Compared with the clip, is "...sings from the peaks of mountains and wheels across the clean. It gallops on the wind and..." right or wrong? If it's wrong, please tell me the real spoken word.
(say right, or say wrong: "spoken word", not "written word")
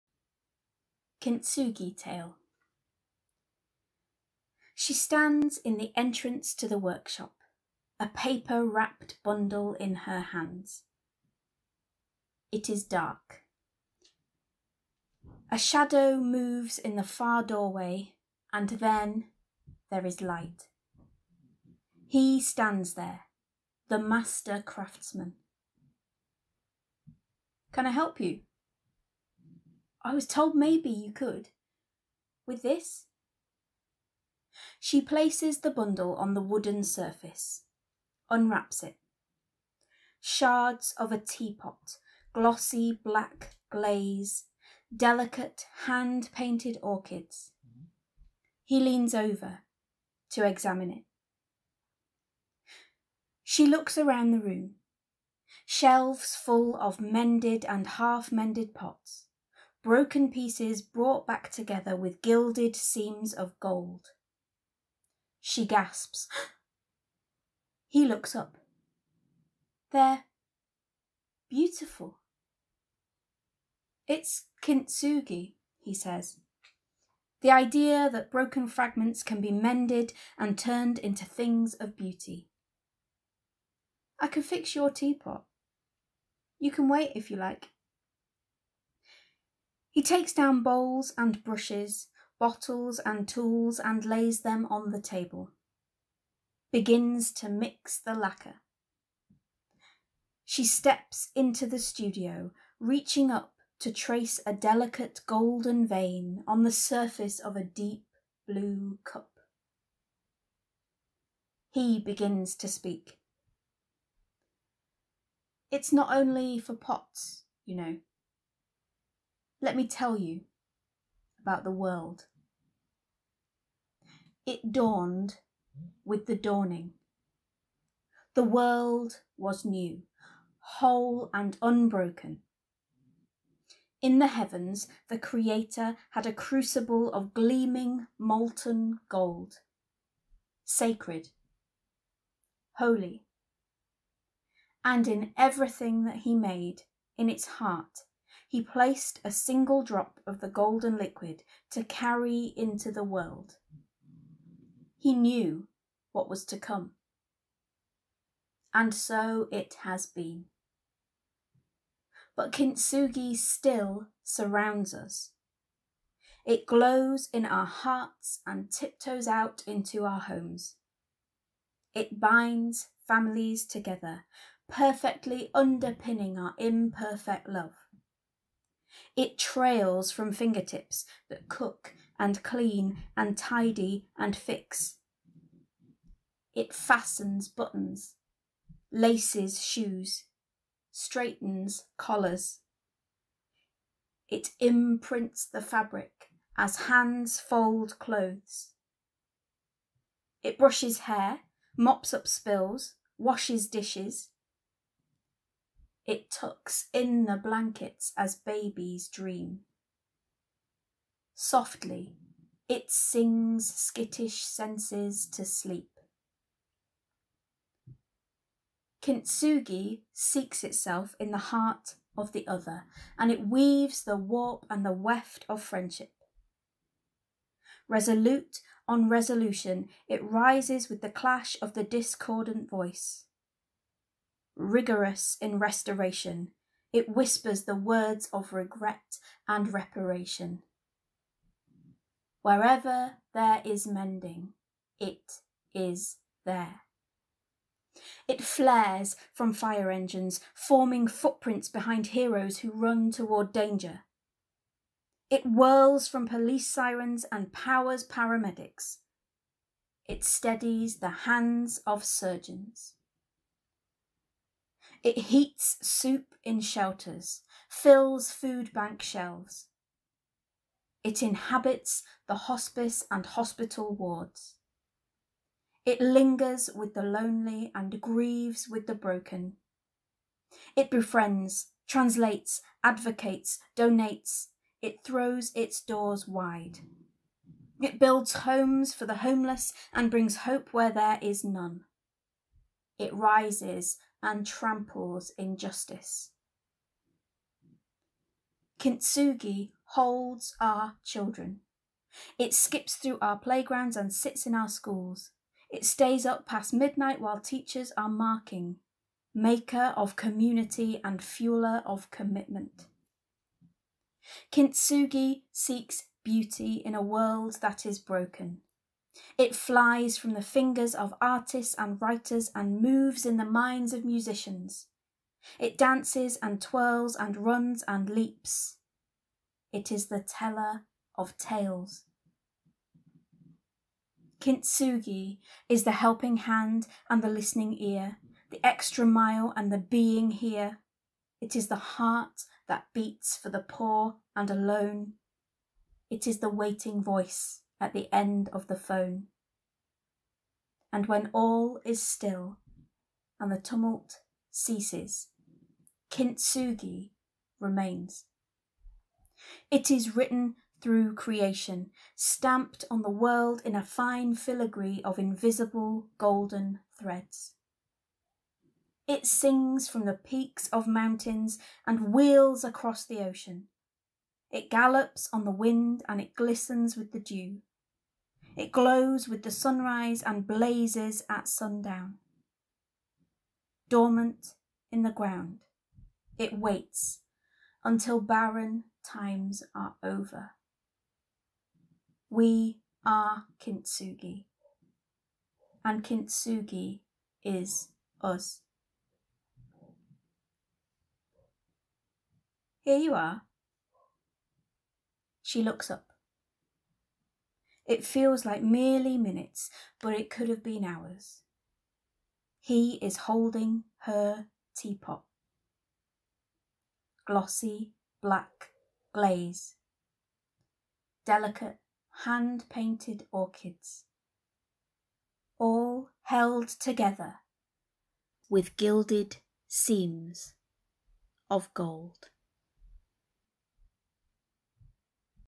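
wrong: "ocean", not "clean".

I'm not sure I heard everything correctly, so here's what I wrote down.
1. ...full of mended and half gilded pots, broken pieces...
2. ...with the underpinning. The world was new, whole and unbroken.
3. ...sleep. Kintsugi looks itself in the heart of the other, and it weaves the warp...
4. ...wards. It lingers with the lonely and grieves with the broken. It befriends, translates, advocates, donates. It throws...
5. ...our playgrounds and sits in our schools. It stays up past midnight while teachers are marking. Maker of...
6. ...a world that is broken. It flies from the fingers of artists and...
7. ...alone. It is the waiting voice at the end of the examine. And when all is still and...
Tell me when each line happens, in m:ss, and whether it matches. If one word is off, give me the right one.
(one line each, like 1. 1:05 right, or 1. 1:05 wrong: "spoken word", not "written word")
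1. 0:56 wrong: "mended", not "gilded"
2. 2:06 wrong: "dawning", not "underpinning"
3. 3:35 wrong: "seeks", not "looks"
4. 4:33 right
5. 5:03 right
6. 5:16 right
7. 5:44 wrong: "phone", not "examine".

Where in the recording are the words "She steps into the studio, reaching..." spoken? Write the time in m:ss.
1:40.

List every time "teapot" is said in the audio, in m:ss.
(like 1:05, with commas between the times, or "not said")
0:41, 1:24, 6:54.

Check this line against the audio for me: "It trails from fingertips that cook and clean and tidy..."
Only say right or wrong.
right.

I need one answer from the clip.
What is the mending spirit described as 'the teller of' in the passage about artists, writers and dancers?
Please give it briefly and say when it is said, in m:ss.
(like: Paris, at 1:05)
Tales, at 5:31.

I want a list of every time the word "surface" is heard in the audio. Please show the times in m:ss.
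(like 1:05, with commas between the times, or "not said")
0:36, 1:46.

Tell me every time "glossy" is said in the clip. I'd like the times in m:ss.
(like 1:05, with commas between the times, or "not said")
0:42, 6:57.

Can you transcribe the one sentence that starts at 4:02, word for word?
Wherever there is mending, it is there.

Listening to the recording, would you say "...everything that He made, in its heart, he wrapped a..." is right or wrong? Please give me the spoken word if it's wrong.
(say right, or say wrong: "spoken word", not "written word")
wrong: "placed", not "wrapped".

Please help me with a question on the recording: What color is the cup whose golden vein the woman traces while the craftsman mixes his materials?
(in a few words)
Deep blue.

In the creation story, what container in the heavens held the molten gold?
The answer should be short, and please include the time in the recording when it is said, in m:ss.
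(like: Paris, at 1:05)
A crucible, at 2:16.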